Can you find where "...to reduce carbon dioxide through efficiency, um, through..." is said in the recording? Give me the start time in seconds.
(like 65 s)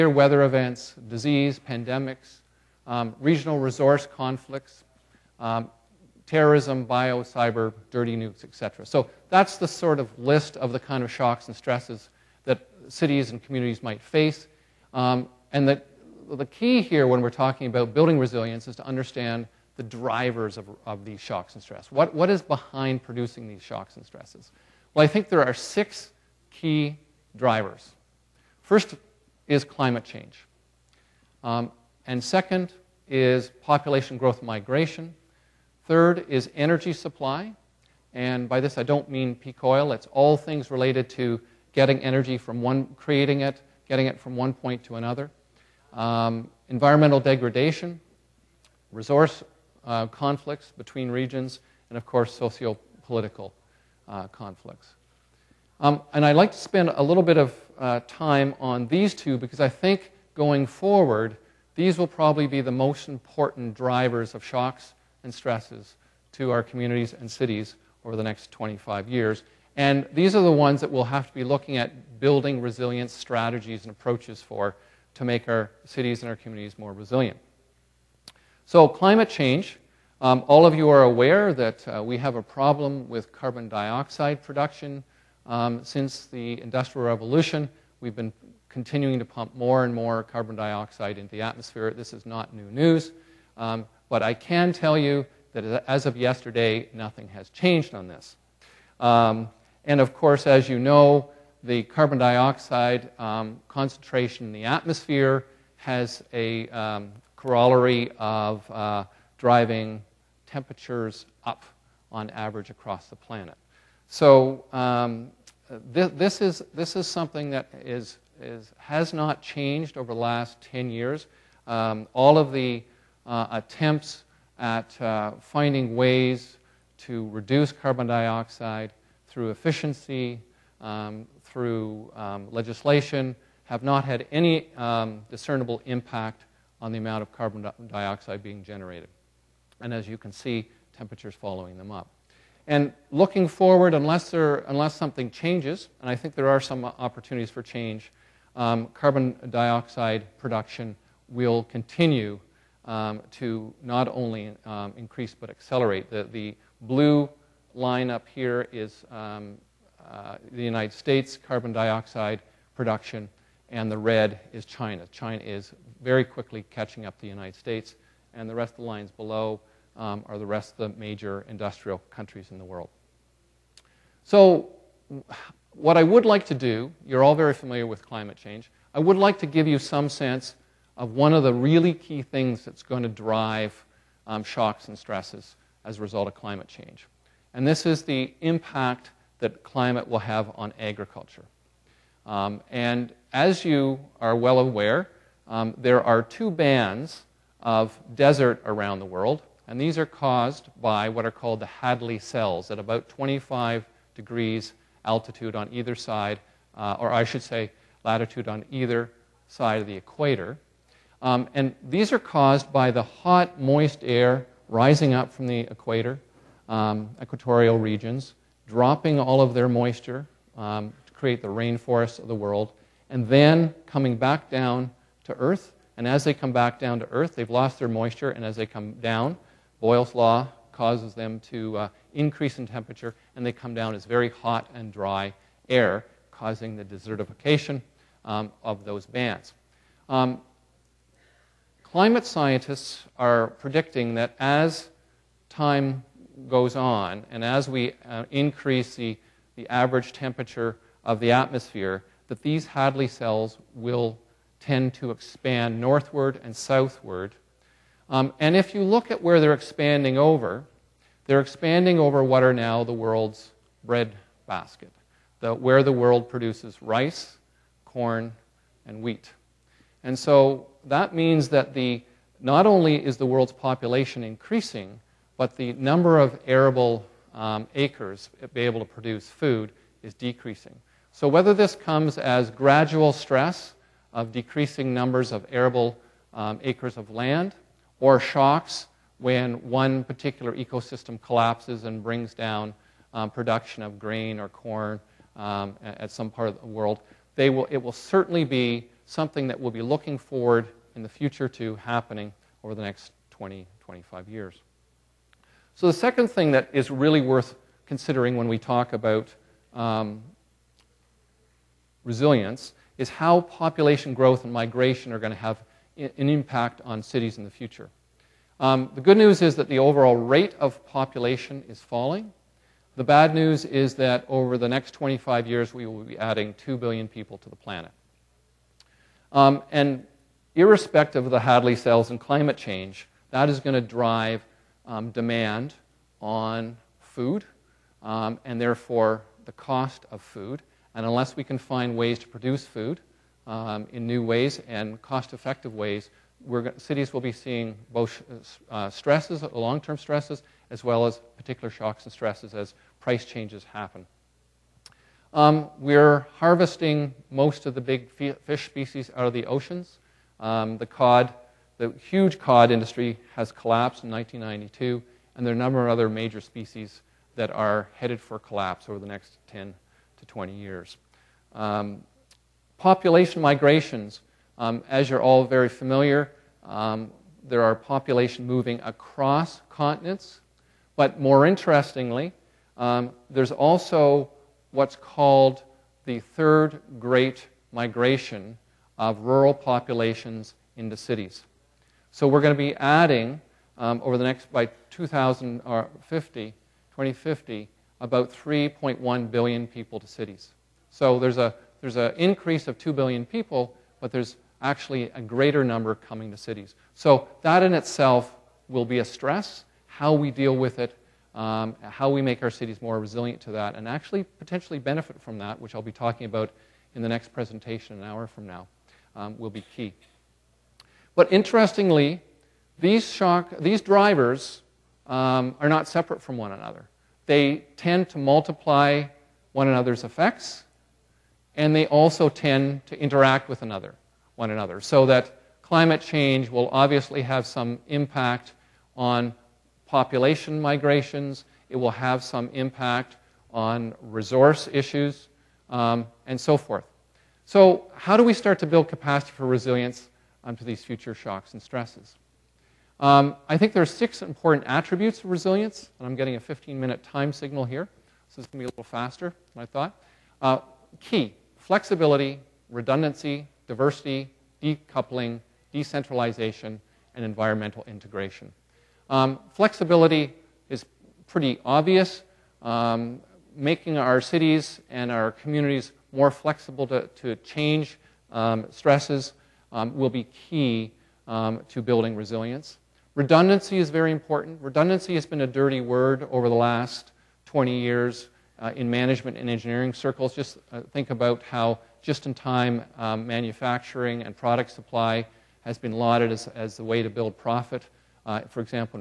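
126 s.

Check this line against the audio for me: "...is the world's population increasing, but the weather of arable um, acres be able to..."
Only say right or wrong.
wrong.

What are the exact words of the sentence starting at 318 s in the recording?
Um, the good news is that the overall rate of population is falling.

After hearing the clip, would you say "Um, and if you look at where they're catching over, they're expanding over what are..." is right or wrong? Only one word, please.
wrong.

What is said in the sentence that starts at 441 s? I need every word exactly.
It will have some impact on resource issues um, and so forth.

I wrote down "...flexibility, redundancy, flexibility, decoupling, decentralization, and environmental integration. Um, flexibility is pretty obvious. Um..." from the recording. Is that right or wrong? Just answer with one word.
wrong.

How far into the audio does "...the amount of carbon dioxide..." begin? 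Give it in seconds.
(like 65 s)
136 s.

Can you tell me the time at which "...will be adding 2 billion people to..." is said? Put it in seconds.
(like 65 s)
325 s.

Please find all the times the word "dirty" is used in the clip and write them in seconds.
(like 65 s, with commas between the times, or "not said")
7 s, 485 s.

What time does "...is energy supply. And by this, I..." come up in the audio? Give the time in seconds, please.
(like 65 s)
36 s.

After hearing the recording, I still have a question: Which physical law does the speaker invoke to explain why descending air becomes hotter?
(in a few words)
Boyle's law.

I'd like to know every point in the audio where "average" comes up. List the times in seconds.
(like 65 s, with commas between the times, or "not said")
112 s, 249 s.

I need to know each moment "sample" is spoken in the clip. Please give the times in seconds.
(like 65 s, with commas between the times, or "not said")
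not said.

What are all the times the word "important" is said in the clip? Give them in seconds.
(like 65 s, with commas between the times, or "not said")
63 s, 454 s, 484 s.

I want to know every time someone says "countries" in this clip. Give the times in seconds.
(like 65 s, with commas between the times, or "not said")
172 s.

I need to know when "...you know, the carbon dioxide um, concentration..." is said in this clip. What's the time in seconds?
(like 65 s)
100 s.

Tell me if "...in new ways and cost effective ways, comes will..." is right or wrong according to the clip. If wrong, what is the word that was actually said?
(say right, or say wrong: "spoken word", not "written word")
wrong: "cities", not "comes".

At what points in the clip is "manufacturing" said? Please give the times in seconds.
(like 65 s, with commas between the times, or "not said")
493 s.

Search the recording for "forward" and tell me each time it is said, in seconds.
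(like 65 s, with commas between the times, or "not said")
60 s, 143 s, 300 s.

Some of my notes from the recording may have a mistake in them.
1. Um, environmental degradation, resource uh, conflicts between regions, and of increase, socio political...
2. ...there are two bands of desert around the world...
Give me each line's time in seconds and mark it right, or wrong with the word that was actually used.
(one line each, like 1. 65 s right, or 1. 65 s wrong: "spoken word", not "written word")
1. 45 s wrong: "course", not "increase"
2. 195 s right.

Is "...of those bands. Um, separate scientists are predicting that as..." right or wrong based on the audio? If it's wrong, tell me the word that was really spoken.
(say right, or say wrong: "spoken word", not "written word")
wrong: "climate", not "separate".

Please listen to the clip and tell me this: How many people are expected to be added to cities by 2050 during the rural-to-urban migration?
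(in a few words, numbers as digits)
3.1 billion.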